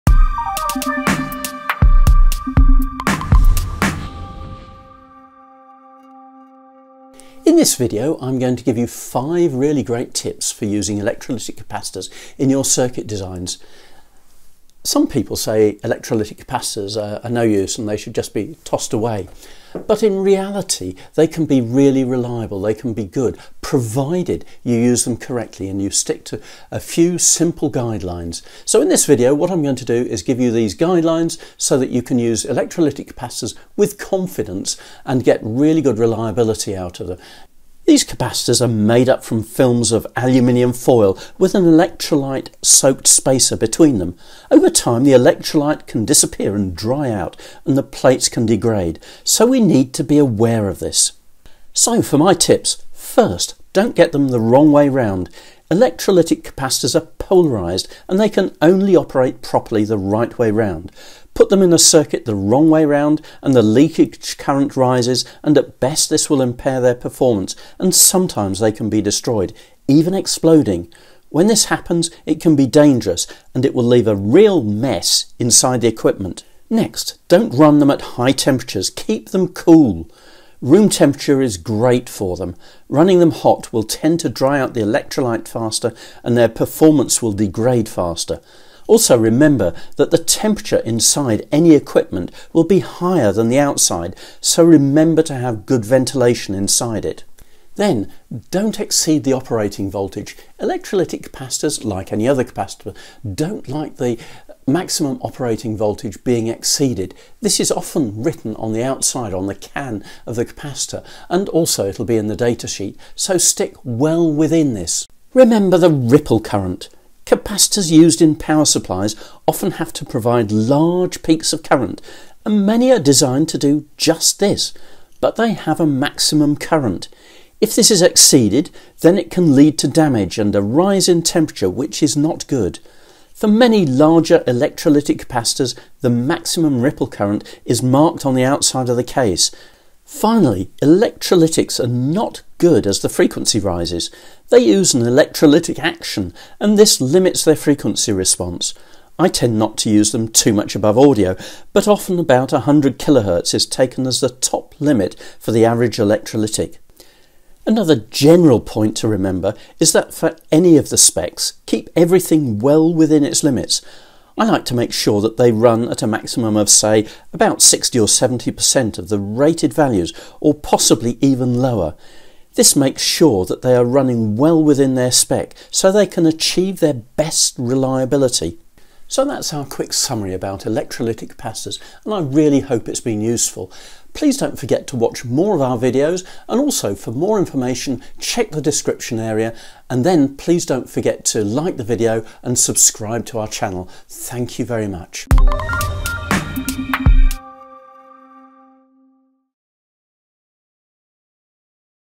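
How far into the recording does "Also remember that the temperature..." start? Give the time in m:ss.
1:28.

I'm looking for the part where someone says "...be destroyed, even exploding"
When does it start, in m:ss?
1:08.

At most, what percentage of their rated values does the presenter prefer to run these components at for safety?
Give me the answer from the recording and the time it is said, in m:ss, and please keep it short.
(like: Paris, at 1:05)
60 or 70%, at 2:47.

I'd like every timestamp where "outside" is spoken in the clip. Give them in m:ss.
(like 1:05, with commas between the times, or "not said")
1:33, 1:48, 2:18.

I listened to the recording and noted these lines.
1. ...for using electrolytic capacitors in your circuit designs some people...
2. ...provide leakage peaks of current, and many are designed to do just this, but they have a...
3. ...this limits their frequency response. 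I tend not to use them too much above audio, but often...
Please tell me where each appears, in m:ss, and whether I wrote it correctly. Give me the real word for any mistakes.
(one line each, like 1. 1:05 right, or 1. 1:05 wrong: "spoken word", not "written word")
1. 0:10 right
2. 2:00 wrong: "large", not "leakage"
3. 2:26 right.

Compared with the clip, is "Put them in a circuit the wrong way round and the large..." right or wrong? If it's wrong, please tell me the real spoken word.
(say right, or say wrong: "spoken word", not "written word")
wrong: "leakage", not "large".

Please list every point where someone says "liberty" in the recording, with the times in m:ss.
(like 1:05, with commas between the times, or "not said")
not said.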